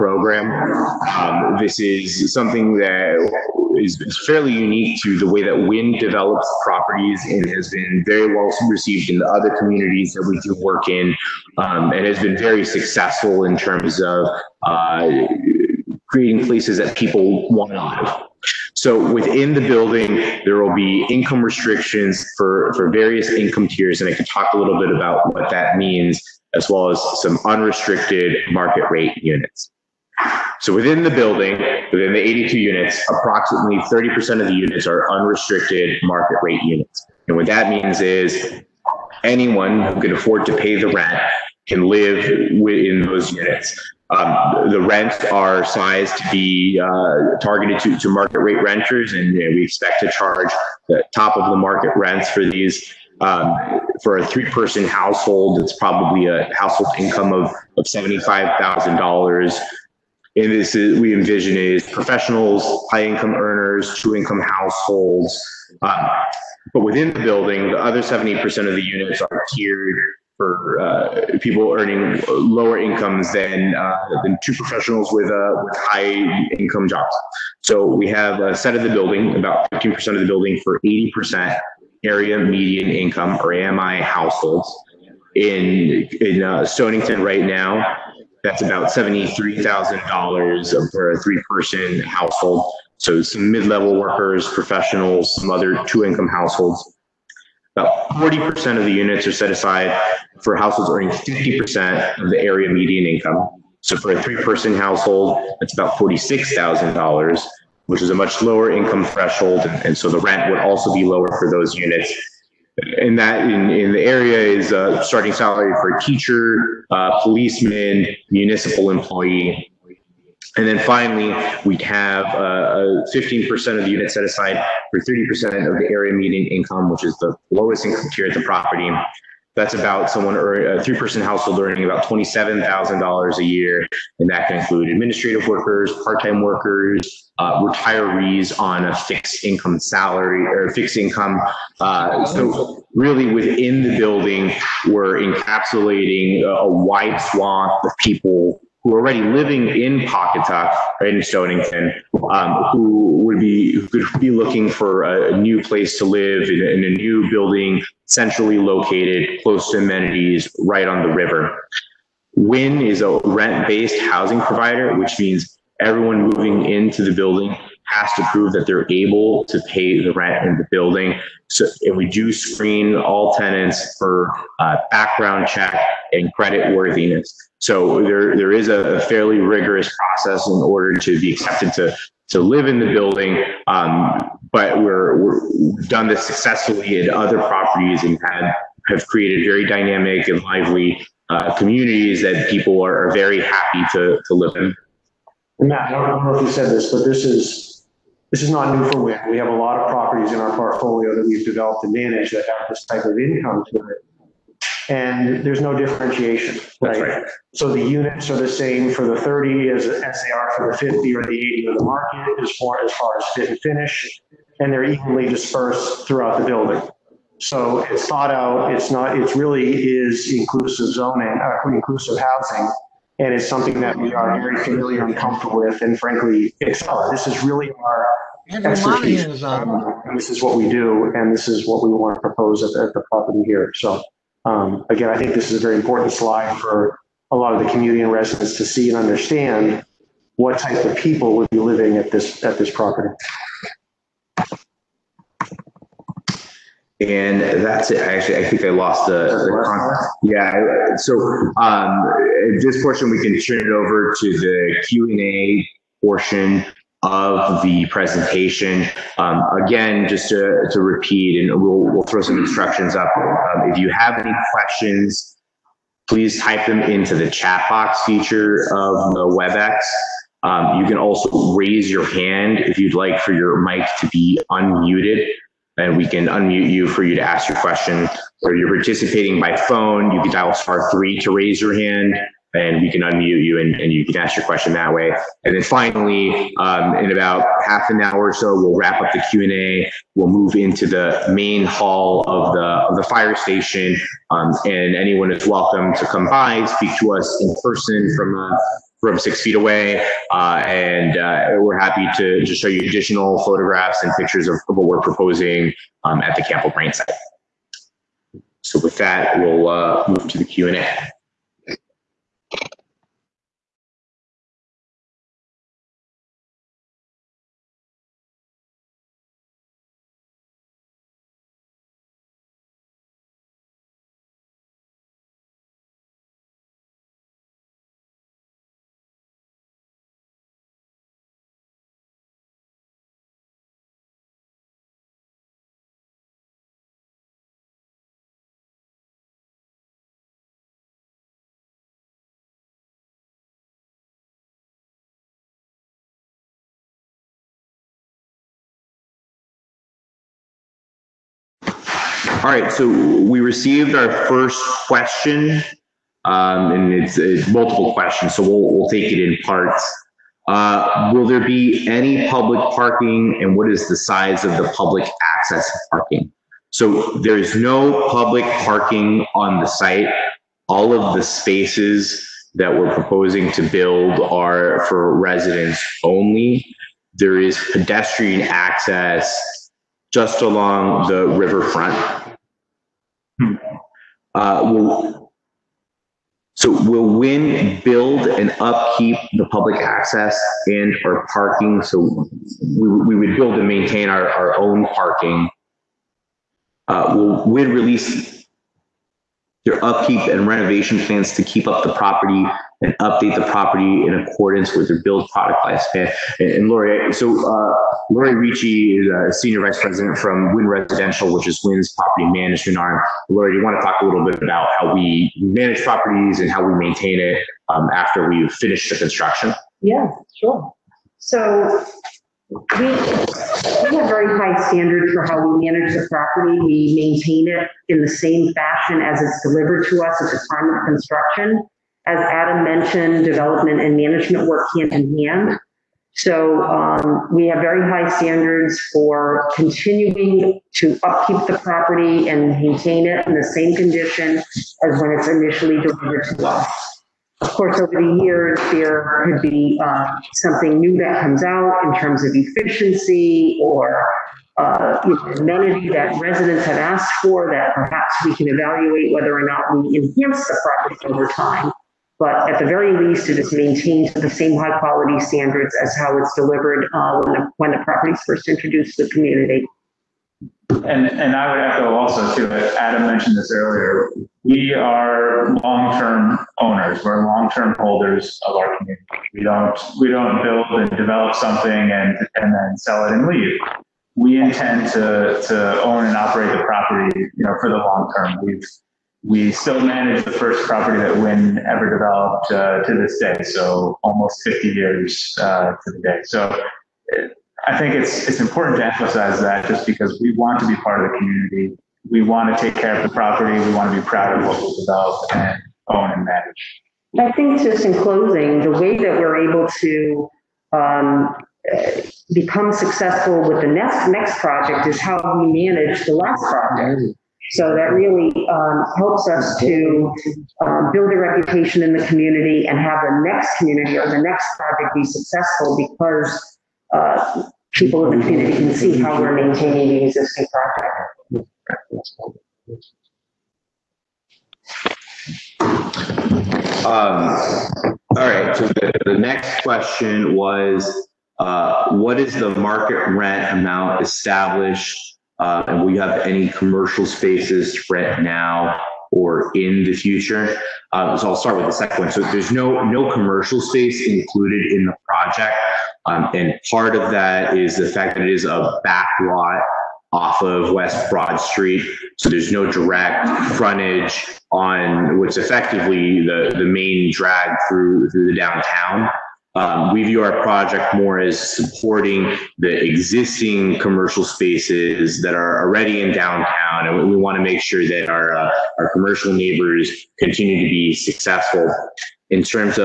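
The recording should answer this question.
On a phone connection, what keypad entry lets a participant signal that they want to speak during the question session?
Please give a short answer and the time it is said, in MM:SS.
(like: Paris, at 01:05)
star three, at 04:40.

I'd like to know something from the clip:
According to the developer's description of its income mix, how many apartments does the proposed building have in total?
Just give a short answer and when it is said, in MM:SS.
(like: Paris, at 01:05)
82, at 00:32.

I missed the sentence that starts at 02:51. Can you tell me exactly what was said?
So, and we do screen all tenants for uh, background check and credit worthiness.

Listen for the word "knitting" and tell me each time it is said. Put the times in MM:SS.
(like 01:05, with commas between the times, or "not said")
not said.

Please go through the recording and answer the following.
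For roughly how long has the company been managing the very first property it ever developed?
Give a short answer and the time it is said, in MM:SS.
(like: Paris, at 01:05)
almost 50 years, at 08:14.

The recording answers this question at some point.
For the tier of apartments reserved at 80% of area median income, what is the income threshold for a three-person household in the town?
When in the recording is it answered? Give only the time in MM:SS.
01:28.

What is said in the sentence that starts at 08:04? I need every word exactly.
We intend to, to own and operate the property, you know, for the long term.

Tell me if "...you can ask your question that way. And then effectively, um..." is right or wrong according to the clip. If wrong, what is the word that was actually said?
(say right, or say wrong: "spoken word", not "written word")
wrong: "finally", not "effectively".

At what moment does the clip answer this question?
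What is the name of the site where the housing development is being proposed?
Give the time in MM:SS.
05:06.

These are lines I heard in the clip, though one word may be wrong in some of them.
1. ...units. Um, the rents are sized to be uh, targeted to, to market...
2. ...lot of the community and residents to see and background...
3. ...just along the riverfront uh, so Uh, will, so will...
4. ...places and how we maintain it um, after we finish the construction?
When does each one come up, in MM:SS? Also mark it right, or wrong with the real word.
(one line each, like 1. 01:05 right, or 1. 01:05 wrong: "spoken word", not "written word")
1. 00:43 right
2. 03:57 wrong: "understand", not "background"
3. 06:20 right
4. 06:55 wrong: "properties", not "places".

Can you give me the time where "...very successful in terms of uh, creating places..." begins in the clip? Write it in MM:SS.
00:12.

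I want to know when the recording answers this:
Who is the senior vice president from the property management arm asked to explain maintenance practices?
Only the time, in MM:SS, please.
06:48.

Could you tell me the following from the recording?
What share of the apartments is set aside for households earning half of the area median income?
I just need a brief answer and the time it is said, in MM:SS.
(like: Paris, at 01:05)
40%, at 01:38.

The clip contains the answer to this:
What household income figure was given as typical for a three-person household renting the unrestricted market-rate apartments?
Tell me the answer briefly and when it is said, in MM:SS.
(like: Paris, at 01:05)
$75,000, at 00:57.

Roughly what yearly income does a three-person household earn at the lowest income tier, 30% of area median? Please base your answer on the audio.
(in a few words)
$27,000.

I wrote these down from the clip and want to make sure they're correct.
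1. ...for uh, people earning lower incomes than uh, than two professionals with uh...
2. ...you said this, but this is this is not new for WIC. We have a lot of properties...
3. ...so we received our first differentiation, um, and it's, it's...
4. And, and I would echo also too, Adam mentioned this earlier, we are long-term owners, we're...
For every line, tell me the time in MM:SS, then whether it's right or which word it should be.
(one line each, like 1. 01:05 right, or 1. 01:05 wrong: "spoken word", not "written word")
1. 01:10 right
2. 03:16 right
3. 05:52 wrong: "question", not "differentiation"
4. 07:50 right.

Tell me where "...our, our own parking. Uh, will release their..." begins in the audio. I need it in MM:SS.
06:34.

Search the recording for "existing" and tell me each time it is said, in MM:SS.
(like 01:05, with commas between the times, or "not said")
08:50, 09:32.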